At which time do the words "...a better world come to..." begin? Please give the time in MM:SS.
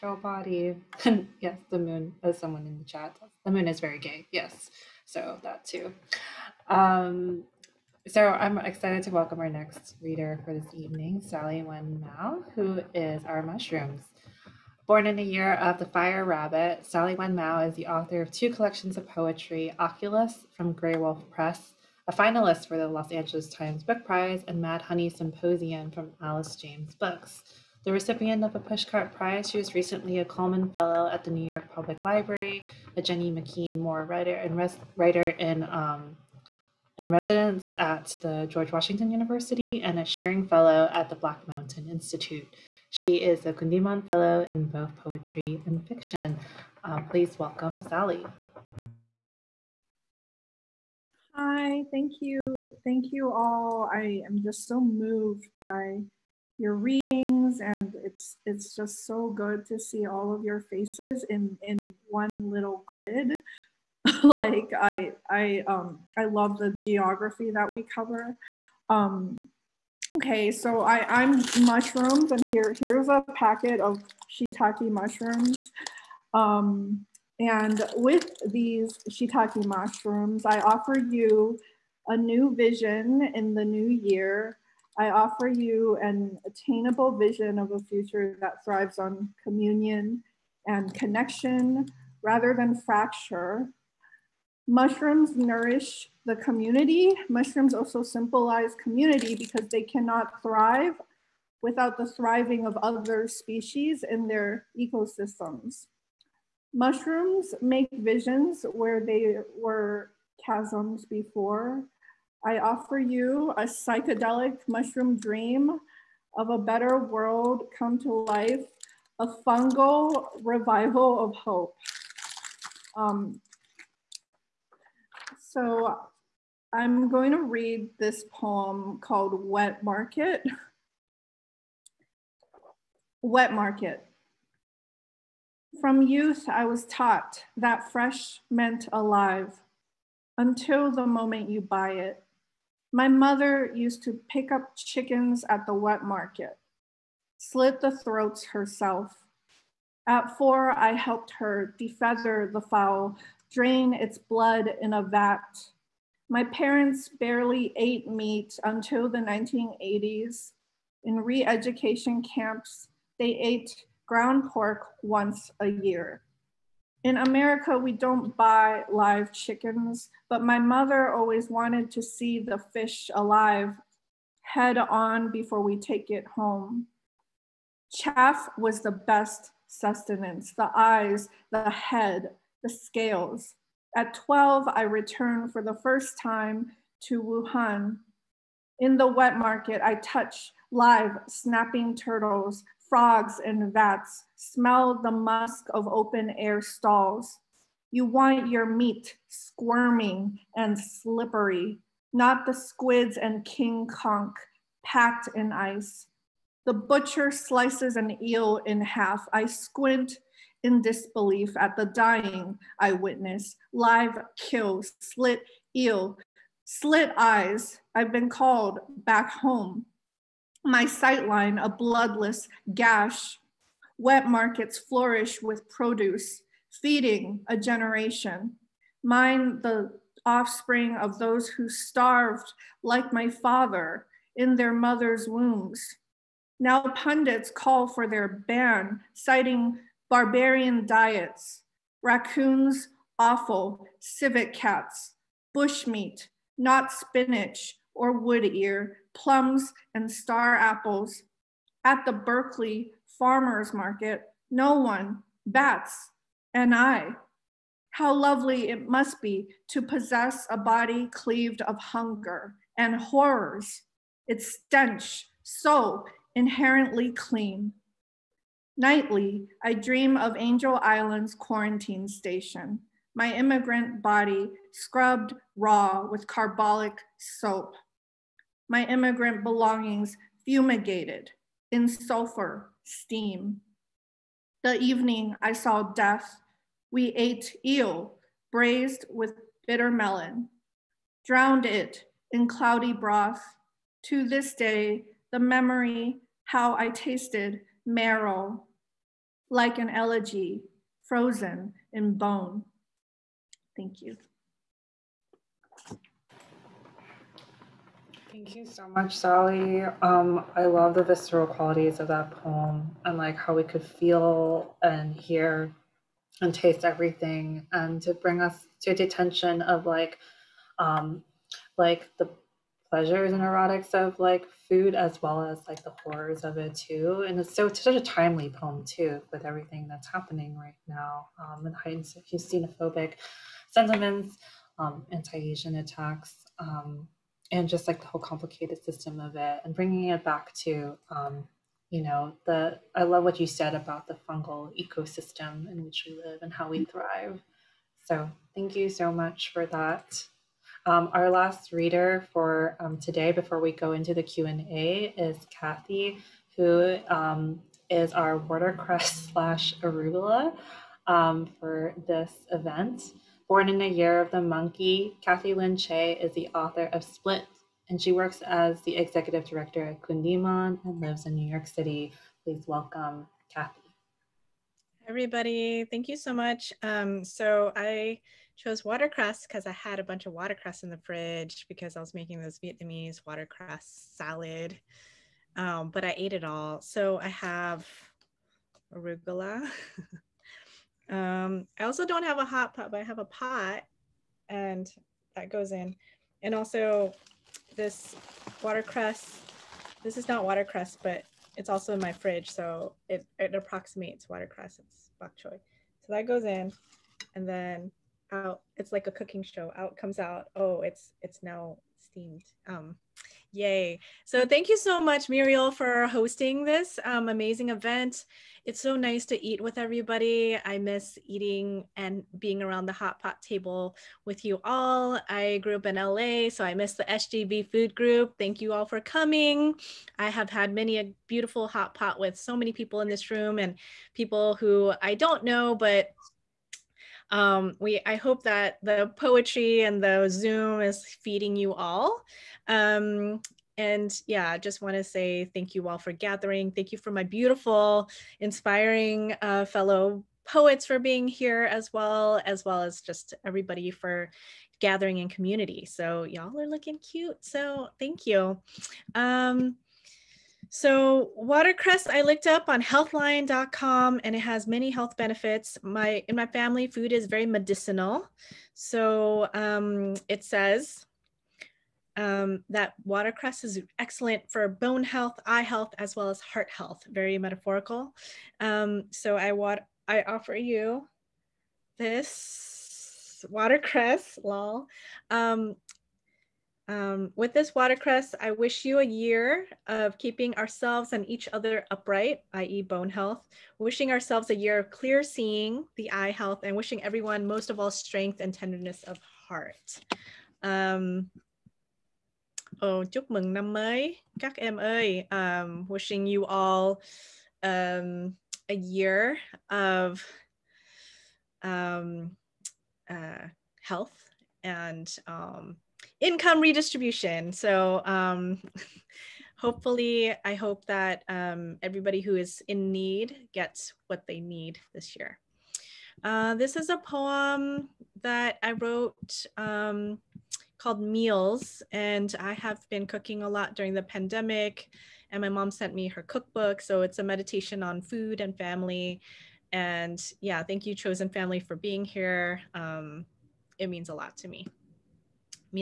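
01:56.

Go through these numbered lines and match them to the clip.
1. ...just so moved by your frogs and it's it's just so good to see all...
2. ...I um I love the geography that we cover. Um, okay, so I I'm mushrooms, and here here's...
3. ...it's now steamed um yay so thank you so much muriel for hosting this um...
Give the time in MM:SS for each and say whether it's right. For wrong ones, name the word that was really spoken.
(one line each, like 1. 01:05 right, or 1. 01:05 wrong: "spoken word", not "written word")
1. 00:54 wrong: "readings", not "frogs"
2. 01:05 right
3. 06:51 right.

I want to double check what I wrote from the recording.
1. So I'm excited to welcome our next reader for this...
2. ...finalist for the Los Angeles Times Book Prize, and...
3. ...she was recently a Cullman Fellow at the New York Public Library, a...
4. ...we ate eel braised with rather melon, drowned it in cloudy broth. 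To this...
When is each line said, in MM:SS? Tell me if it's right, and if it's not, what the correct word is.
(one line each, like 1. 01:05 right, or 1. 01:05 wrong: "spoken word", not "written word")
1. 00:08 right
2. 00:22 right
3. 00:29 right
4. 04:46 wrong: "bitter", not "rather".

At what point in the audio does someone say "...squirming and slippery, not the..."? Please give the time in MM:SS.
03:19.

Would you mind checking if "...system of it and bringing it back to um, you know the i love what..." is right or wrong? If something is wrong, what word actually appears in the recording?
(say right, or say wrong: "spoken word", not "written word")
right.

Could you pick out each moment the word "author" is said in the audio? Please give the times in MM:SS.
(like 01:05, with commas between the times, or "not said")
00:17, 06:06.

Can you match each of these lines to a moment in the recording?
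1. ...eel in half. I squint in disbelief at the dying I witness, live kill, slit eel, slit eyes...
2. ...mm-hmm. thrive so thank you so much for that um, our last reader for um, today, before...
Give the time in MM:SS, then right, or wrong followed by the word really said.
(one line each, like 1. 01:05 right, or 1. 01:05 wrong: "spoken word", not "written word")
1. 03:28 right
2. 05:46 right.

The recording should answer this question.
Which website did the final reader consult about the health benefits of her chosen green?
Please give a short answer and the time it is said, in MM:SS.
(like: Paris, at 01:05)
healthline.com, at 07:42.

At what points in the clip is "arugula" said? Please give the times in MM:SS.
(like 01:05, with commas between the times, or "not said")
05:59, 06:28.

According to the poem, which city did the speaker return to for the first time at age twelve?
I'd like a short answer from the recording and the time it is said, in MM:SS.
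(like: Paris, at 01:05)
Wuhan, at 03:07.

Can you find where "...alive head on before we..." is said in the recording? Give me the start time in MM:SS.
02:53.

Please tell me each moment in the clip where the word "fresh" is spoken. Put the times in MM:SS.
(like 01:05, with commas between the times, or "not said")
02:17.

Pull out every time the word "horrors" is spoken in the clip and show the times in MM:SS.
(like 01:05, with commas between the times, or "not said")
04:23, 05:26.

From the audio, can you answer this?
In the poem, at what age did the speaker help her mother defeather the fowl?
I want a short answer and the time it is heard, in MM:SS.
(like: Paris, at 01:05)
4, at 02:30.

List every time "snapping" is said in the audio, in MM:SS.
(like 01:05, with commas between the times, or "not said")
03:11.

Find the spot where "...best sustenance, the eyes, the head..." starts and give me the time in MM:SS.
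02:58.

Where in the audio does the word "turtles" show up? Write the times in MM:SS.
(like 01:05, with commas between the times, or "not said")
03:11.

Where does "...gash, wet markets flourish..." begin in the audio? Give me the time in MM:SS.
03:42.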